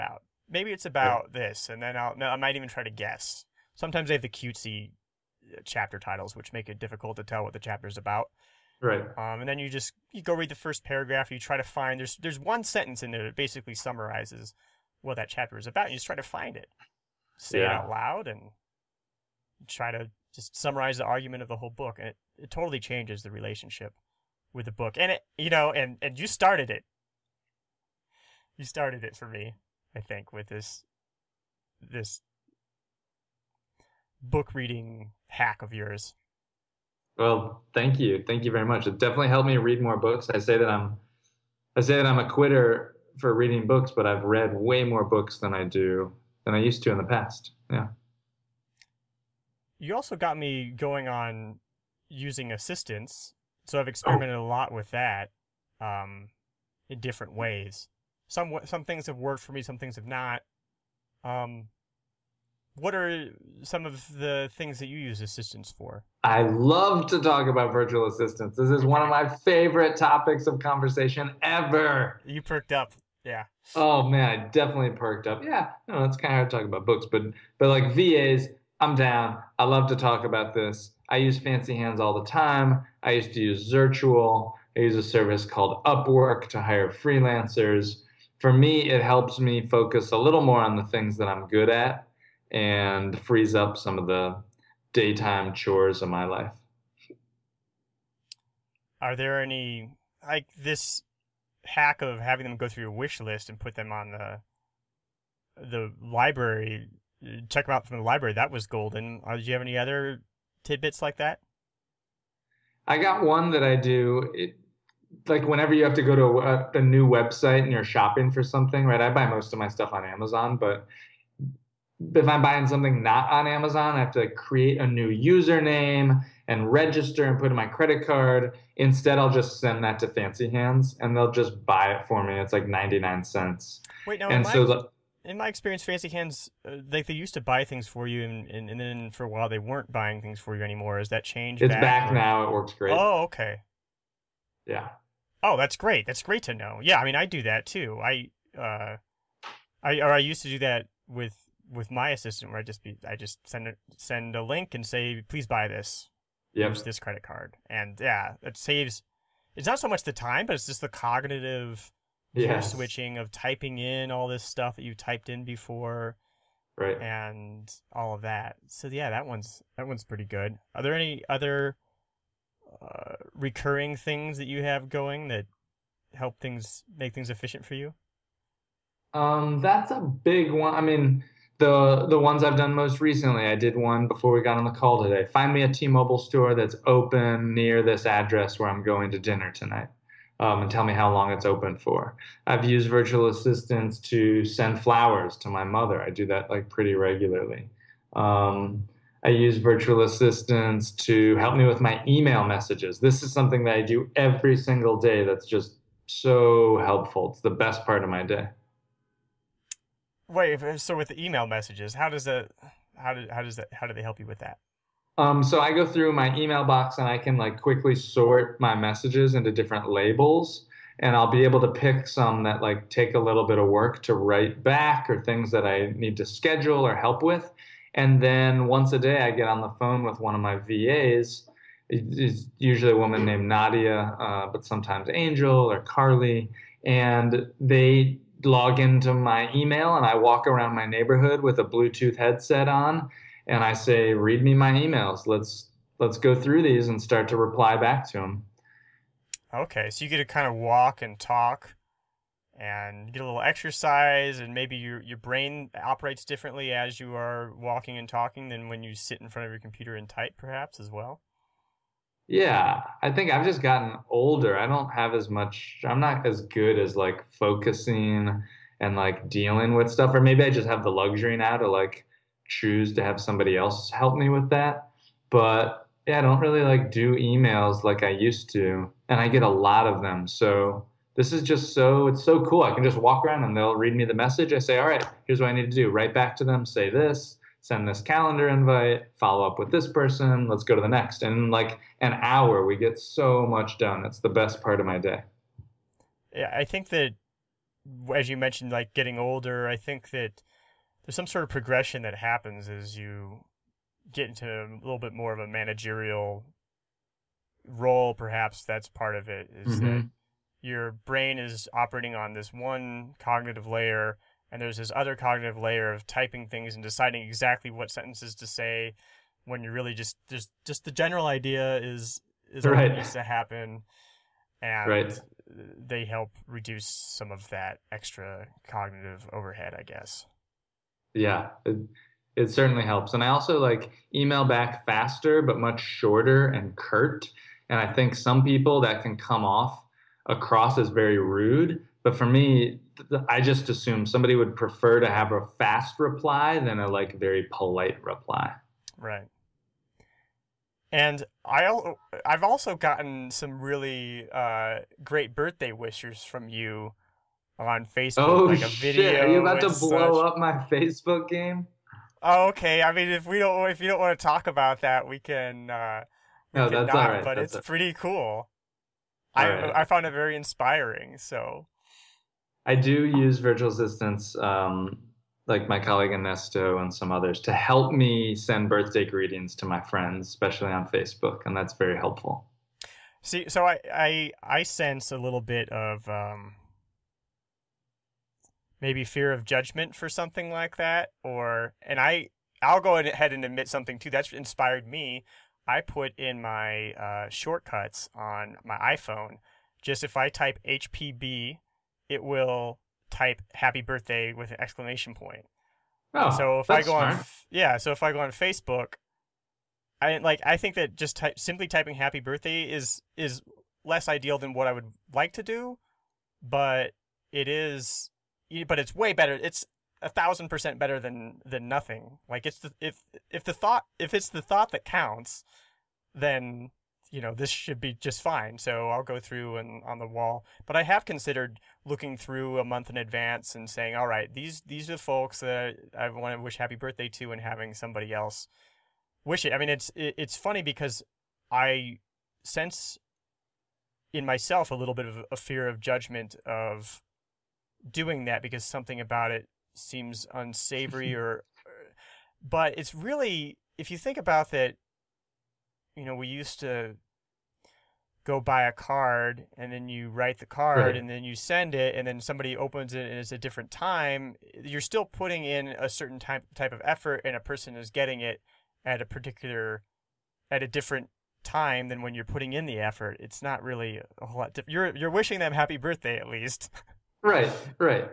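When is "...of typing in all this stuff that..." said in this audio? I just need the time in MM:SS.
02:43.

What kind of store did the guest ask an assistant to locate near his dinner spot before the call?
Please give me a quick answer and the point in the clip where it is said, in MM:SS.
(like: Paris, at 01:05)
T-Mobile store, at 03:05.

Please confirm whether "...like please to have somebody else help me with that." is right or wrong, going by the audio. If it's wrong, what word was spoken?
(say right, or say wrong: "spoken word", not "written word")
wrong: "choose", not "please".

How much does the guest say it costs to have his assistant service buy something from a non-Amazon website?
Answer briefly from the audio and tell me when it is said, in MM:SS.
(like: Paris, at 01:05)
99 cents, at 02:12.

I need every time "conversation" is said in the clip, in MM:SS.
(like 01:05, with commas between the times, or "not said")
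01:10.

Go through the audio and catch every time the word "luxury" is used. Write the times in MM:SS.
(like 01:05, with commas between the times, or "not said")
04:30.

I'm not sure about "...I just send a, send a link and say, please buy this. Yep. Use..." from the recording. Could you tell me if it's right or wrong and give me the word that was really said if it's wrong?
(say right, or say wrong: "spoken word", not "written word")
right.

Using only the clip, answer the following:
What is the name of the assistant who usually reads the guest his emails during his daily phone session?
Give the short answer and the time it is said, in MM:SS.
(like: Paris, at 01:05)
Nadia, at 03:53.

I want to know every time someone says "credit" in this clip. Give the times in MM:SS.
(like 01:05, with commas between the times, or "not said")
02:07, 02:36.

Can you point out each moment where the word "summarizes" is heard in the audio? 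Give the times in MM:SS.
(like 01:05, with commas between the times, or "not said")
00:13, 00:20.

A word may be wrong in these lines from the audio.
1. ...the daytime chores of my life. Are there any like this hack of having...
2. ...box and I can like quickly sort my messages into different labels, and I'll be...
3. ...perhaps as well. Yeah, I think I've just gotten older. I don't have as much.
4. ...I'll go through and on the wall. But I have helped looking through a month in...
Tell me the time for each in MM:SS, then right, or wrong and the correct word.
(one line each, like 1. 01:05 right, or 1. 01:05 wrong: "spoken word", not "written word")
1. 01:34 right
2. 03:36 right
3. 04:20 right
4. 07:08 wrong: "considered", not "helped".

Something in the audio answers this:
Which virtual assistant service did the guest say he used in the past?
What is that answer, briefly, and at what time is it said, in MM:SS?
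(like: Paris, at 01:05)
Zirtual, at 01:23.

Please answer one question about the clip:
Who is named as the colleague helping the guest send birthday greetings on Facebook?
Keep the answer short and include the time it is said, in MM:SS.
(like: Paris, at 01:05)
Ernesto, at 06:16.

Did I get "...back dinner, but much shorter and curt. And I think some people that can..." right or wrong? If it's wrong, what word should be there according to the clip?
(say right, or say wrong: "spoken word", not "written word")
wrong: "faster", not "dinner".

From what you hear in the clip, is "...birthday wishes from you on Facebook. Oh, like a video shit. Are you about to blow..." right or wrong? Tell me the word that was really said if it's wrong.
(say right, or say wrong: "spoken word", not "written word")
right.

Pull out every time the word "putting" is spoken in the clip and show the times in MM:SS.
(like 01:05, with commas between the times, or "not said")
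07:45, 07:52.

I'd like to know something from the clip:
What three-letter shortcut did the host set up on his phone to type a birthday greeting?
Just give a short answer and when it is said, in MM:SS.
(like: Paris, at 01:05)
hpb, at 06:40.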